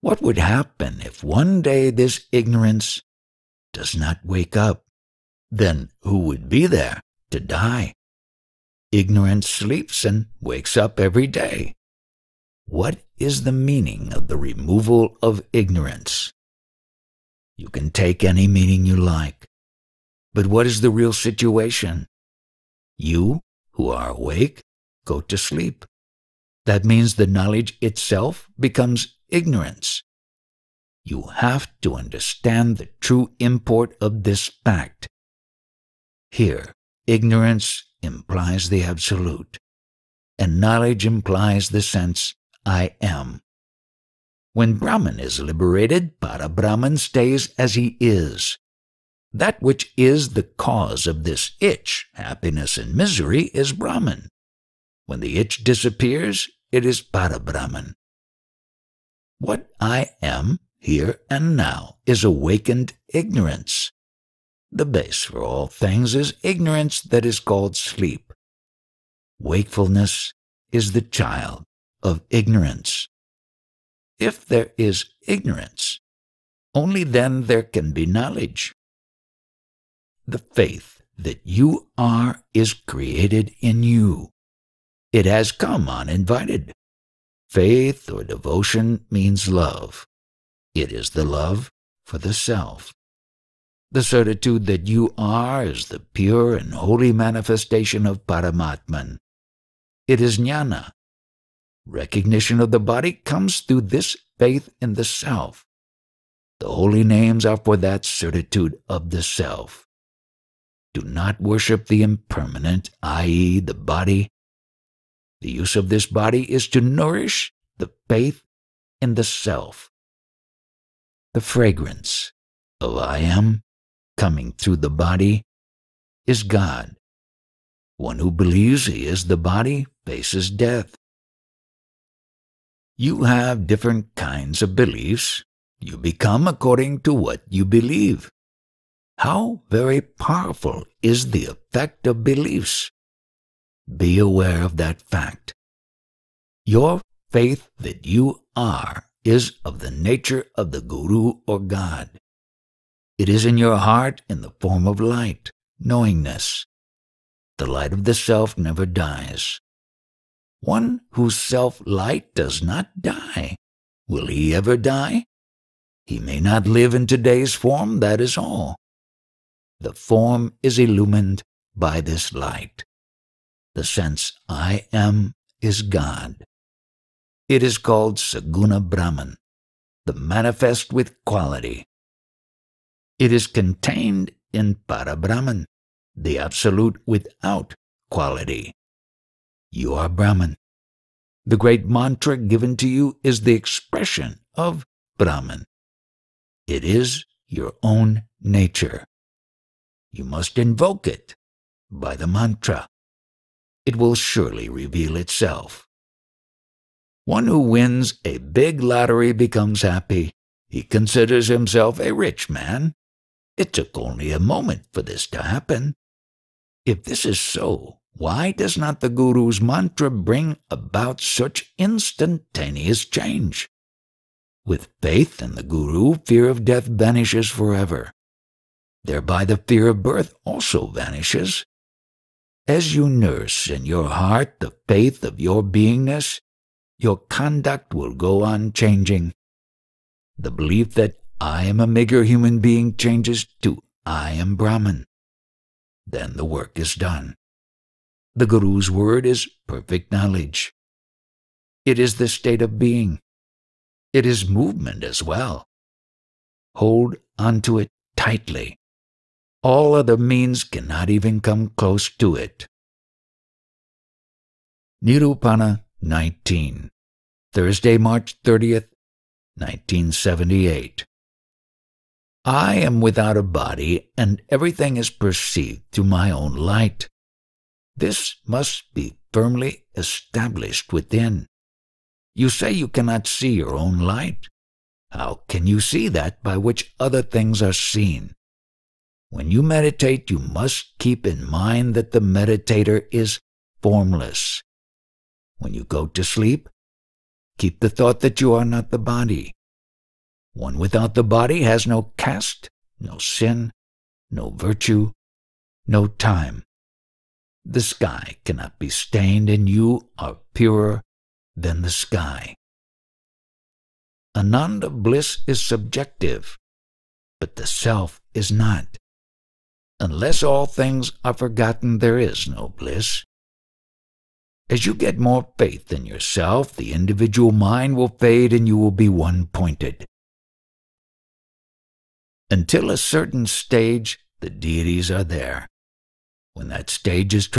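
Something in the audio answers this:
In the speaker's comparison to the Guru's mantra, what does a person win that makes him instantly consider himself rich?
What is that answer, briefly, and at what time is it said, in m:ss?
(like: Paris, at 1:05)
A big lottery, at 3:28.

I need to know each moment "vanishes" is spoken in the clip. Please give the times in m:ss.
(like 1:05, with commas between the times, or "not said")
3:46, 3:50.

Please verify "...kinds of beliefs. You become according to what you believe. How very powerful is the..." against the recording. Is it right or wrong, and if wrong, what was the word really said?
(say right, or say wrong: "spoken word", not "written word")
right.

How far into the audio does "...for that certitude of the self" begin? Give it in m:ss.
1:47.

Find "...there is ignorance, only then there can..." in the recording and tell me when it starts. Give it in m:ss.
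1:14.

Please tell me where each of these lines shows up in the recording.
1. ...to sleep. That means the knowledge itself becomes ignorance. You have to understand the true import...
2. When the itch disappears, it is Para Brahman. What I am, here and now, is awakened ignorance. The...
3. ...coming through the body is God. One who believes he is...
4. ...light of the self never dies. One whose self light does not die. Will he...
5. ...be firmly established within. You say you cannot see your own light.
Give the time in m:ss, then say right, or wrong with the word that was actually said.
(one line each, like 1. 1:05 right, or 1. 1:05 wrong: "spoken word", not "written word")
1. 0:25 right
2. 0:55 right
3. 2:04 right
4. 2:37 right
5. 4:38 right.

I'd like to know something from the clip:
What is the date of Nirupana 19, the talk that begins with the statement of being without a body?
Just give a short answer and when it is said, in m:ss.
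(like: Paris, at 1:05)
March 30th, 1978, at 4:27.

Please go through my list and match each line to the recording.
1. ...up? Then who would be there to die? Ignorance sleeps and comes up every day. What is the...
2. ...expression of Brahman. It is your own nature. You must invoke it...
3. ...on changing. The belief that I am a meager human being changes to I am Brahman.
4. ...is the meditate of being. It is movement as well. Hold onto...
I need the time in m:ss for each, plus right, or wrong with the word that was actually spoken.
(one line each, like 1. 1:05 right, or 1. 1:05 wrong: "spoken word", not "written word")
1. 0:04 wrong: "wakes", not "comes"
2. 3:13 right
3. 3:58 right
4. 4:11 wrong: "state", not "meditate".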